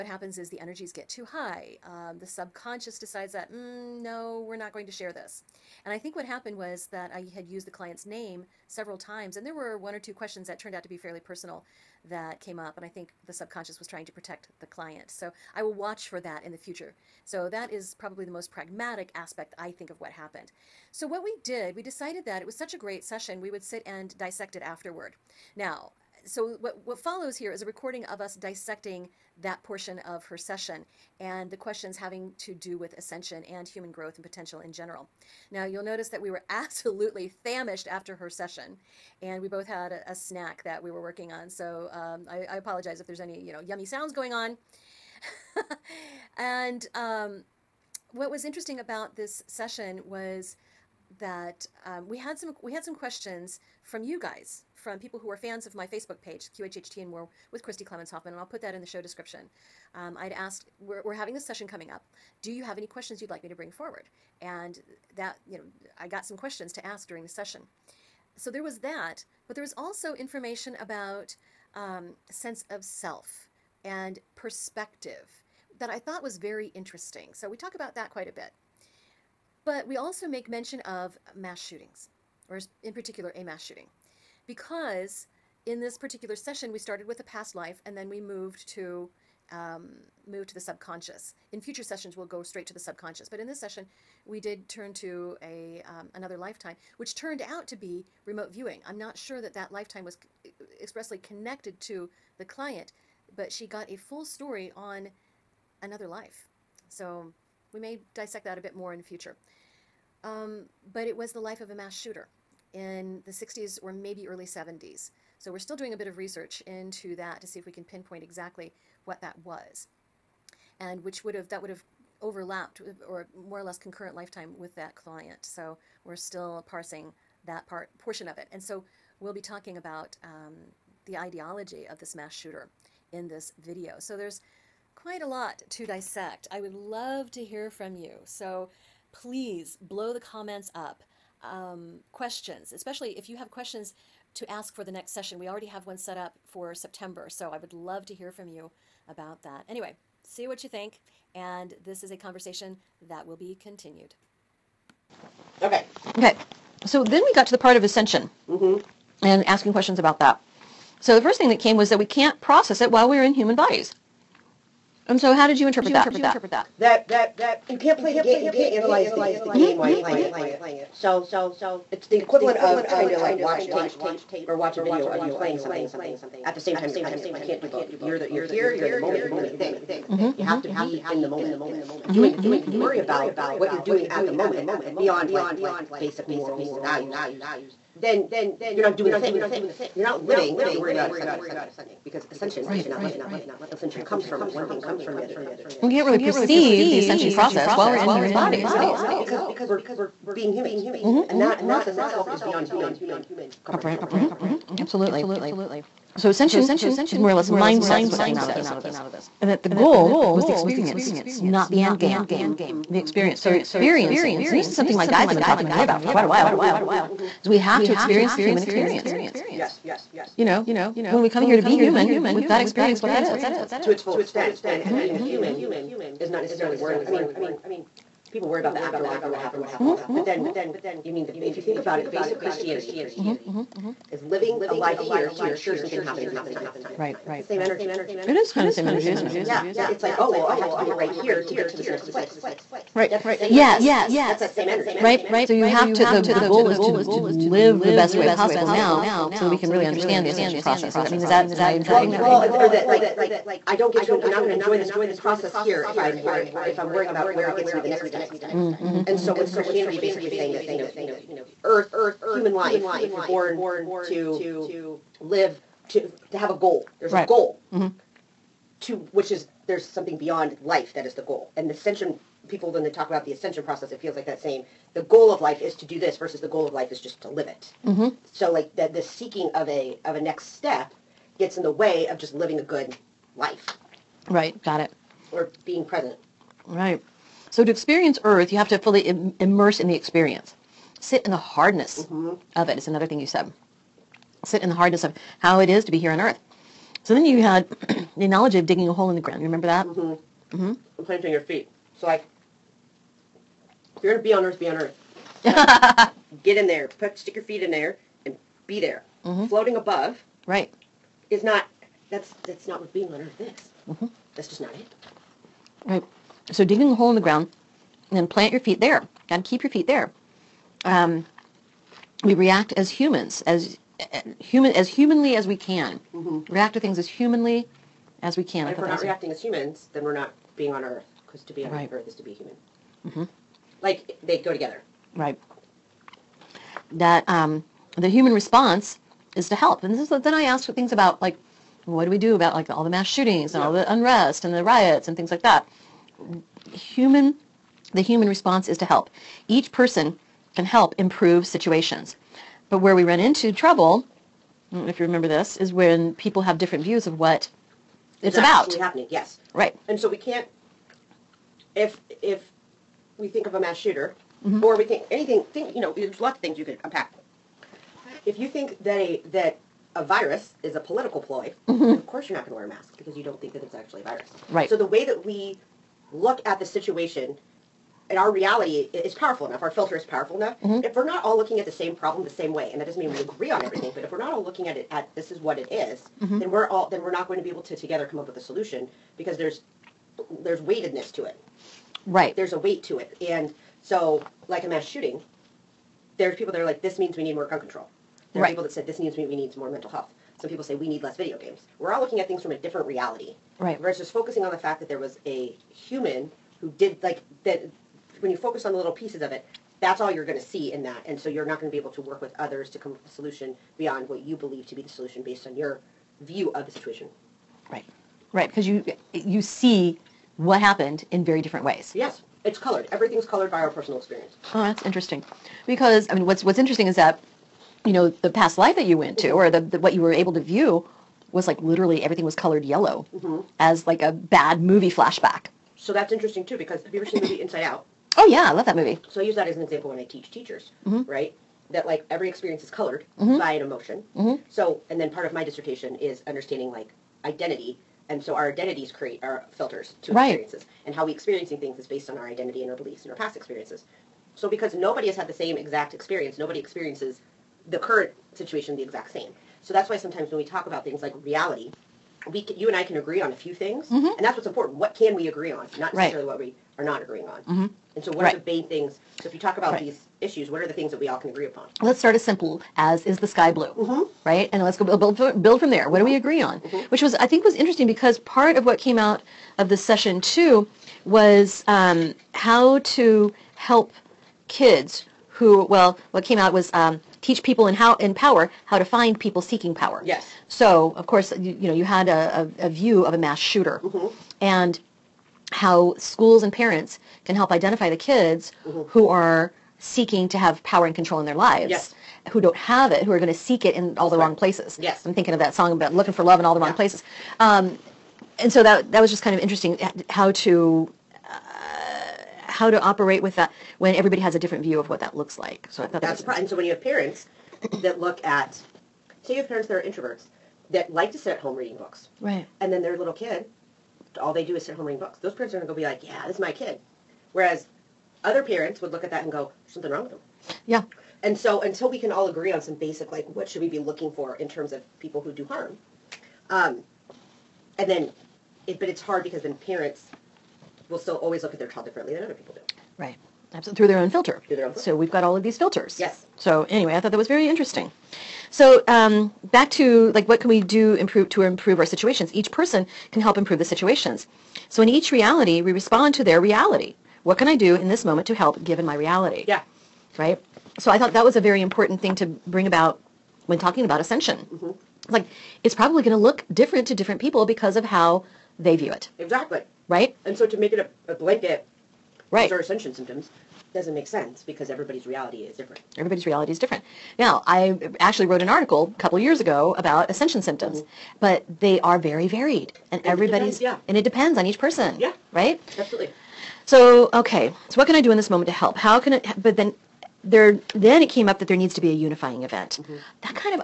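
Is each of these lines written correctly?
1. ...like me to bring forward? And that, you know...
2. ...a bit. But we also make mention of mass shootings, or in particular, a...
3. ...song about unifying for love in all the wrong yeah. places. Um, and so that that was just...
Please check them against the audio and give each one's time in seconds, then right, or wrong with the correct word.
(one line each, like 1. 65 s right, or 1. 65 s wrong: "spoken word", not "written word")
1. 63 s right
2. 78 s right
3. 505 s wrong: "looking", not "unifying".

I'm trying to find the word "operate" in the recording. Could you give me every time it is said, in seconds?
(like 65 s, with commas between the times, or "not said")
512 s.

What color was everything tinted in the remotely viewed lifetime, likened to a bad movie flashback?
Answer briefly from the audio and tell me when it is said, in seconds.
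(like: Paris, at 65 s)
Yellow, at 432 s.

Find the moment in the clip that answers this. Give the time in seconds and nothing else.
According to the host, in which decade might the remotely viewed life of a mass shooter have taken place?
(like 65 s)
113 s.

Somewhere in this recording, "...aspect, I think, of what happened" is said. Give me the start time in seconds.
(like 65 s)
19 s.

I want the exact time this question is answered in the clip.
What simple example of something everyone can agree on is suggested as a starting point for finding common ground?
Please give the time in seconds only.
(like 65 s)
473 s.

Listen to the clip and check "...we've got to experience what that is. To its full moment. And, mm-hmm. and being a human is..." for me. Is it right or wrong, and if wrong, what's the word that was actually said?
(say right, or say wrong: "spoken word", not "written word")
wrong: "extent", not "moment".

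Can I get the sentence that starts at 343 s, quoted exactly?
all the unrest and the riots and things like that?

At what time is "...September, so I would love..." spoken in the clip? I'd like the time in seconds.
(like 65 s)
146 s.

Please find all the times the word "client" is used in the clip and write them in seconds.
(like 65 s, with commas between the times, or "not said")
7 s, 14 s, 102 s, 124 s.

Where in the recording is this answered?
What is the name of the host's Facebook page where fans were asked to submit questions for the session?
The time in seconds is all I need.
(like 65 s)
56 s.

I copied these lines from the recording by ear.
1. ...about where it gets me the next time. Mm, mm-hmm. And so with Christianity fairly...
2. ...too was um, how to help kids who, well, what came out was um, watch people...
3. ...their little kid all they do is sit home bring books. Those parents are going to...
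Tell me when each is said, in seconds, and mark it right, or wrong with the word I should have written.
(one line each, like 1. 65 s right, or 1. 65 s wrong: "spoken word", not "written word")
1. 257 s wrong: "basically", not "fairly"
2. 480 s wrong: "teach", not "watch"
3. 522 s wrong: "reading", not "bring".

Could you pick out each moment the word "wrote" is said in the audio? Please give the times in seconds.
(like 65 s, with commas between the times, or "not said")
578 s.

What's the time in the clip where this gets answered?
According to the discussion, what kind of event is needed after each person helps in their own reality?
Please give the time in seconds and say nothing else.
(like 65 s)
591 s.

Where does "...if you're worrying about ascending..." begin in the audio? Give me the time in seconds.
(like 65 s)
190 s.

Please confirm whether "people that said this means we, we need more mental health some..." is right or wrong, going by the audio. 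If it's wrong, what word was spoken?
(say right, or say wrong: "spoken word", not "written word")
right.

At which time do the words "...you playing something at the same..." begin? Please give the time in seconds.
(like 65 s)
175 s.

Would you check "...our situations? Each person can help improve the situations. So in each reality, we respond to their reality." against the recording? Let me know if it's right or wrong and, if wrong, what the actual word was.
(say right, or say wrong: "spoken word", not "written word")
right.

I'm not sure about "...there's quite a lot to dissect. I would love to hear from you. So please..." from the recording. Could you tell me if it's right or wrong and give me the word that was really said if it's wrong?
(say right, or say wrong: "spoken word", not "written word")
right.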